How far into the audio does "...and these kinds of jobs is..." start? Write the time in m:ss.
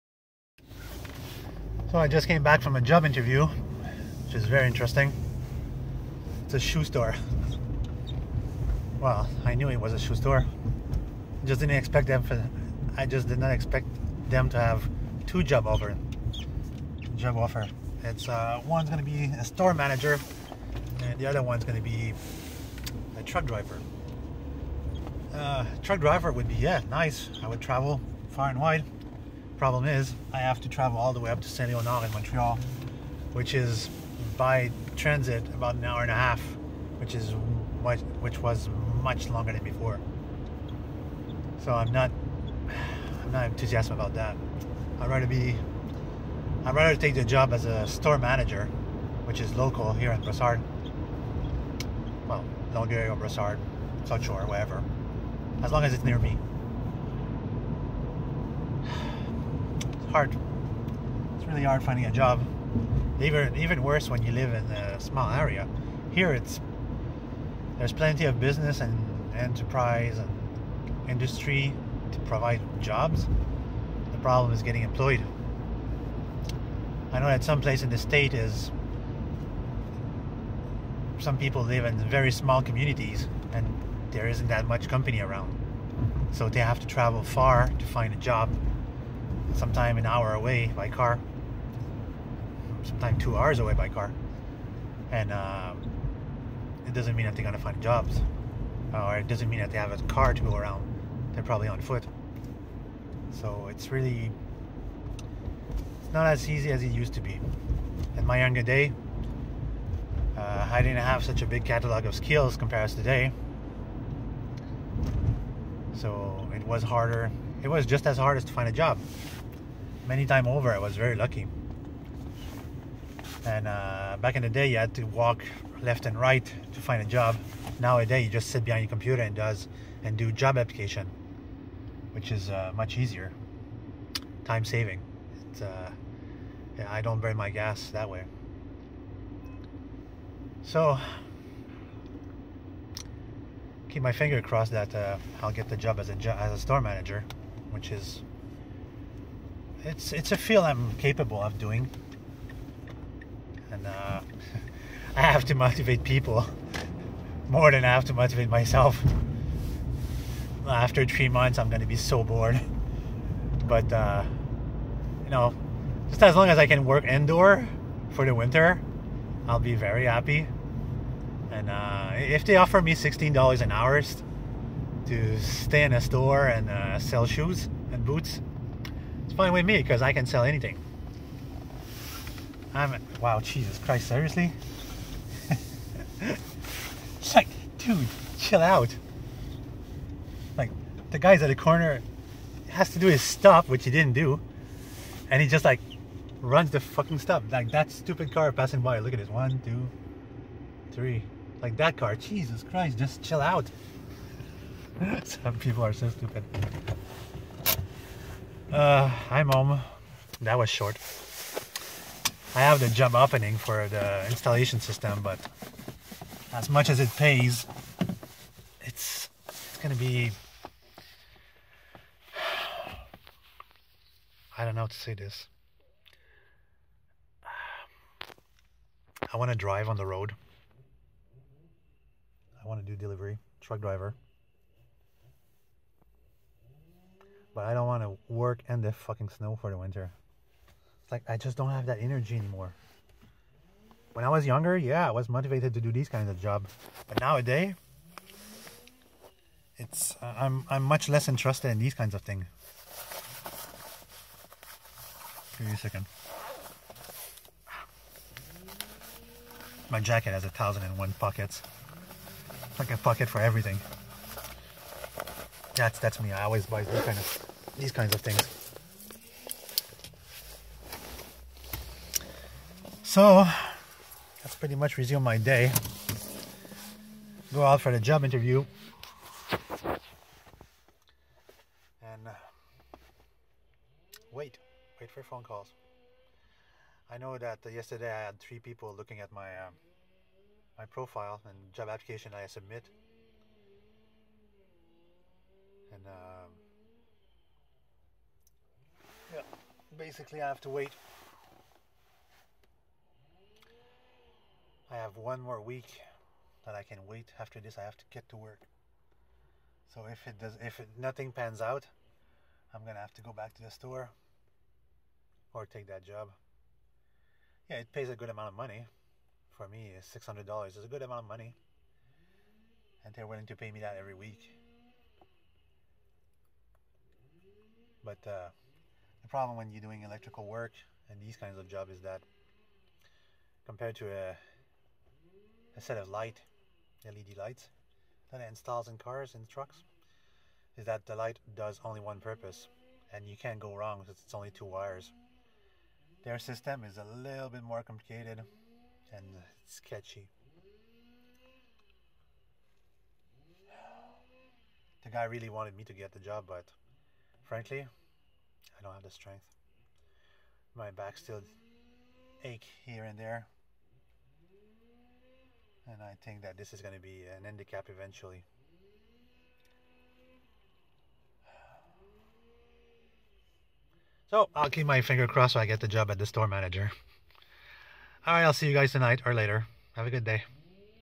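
5:31.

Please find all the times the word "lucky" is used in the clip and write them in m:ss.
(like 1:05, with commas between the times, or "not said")
2:01.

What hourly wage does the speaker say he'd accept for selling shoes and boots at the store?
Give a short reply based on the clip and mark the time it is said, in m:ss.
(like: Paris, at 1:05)
$16 an hour, at 2:52.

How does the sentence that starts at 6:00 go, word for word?
My back still ache here and there.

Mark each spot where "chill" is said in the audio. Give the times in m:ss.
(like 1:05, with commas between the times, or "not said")
3:08, 3:23.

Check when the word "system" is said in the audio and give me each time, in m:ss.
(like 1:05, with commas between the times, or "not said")
3:34, 5:46.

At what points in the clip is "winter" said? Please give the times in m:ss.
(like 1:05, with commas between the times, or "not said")
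2:48, 3:59.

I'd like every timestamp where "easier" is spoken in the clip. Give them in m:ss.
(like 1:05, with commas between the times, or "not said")
2:12.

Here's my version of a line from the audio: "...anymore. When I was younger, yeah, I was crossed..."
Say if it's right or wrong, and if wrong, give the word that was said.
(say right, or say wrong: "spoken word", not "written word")
wrong: "motivated", not "crossed".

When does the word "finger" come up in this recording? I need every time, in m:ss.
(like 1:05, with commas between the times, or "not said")
2:24, 6:15.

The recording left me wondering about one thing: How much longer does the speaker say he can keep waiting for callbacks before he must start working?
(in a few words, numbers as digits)
one more week.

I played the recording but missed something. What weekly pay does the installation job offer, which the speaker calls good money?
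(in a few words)
$600.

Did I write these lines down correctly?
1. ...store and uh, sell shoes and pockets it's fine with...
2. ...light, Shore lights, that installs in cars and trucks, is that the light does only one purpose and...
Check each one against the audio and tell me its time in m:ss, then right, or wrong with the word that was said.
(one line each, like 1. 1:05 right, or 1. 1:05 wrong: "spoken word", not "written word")
1. 2:56 wrong: "boots", not "pockets"
2. 5:36 wrong: "LED", not "Shore".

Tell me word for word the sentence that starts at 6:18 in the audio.
All right, I'll see you guys tonight or later.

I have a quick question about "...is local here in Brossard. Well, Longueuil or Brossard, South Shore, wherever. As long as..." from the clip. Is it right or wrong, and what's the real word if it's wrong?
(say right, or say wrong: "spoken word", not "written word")
right.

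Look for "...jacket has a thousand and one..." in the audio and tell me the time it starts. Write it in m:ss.
4:19.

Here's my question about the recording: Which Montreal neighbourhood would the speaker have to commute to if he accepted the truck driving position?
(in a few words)
Saint Leonard.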